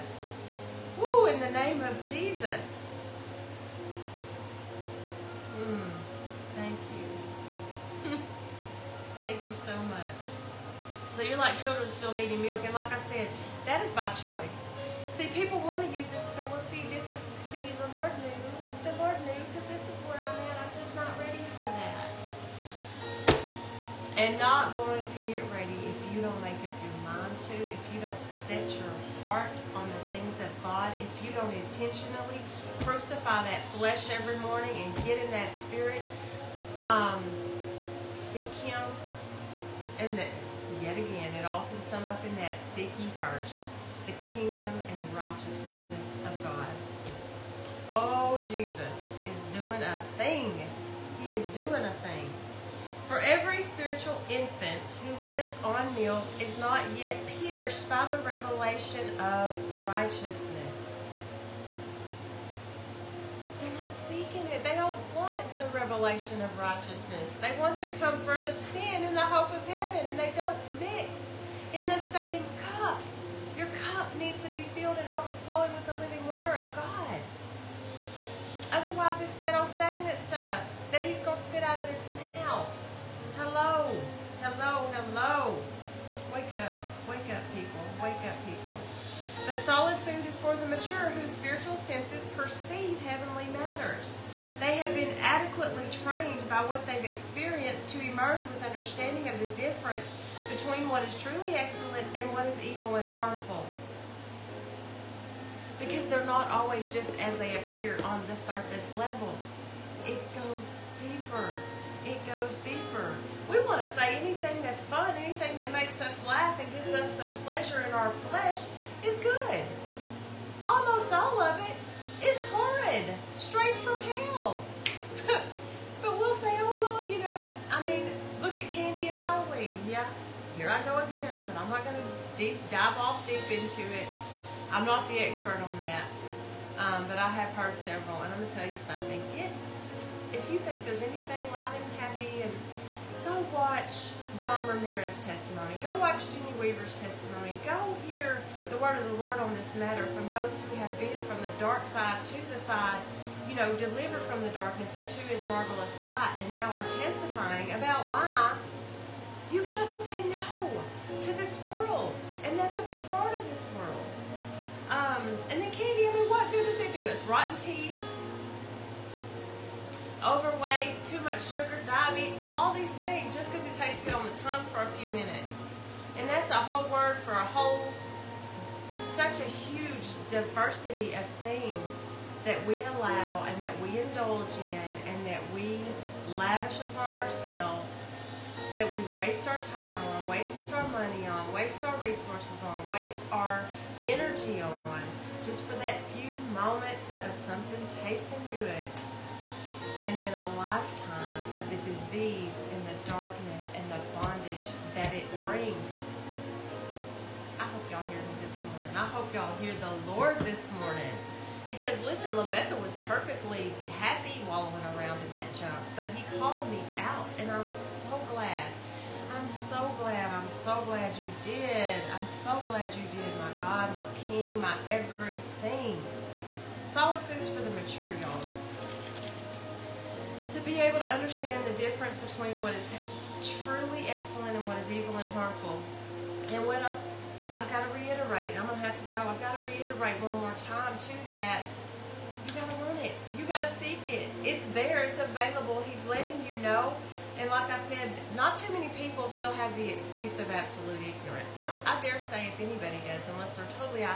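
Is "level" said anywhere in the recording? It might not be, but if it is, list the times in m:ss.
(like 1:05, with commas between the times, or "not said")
1:48.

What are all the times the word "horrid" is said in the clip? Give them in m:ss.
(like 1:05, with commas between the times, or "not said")
2:02.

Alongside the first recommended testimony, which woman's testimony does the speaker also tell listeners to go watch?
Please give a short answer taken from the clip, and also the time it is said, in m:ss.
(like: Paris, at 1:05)
Jenny Weaver, at 2:26.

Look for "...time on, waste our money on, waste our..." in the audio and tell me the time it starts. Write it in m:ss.
3:09.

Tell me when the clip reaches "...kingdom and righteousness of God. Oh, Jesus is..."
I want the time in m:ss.
0:44.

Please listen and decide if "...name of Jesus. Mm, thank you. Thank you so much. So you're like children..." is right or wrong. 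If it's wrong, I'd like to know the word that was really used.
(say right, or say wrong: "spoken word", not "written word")
right.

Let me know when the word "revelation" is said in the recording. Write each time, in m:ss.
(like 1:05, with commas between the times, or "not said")
0:58, 1:05.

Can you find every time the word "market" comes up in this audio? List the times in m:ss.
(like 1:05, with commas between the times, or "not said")
not said.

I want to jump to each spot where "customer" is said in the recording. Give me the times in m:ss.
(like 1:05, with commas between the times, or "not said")
not said.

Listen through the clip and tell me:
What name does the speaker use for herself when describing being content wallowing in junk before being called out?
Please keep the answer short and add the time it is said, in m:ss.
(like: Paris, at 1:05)
LaBetha, at 3:32.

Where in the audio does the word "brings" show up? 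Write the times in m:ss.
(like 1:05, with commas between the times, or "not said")
3:25.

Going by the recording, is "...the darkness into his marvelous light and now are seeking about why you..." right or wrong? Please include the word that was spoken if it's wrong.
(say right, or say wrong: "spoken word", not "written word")
wrong: "testifying", not "seeking".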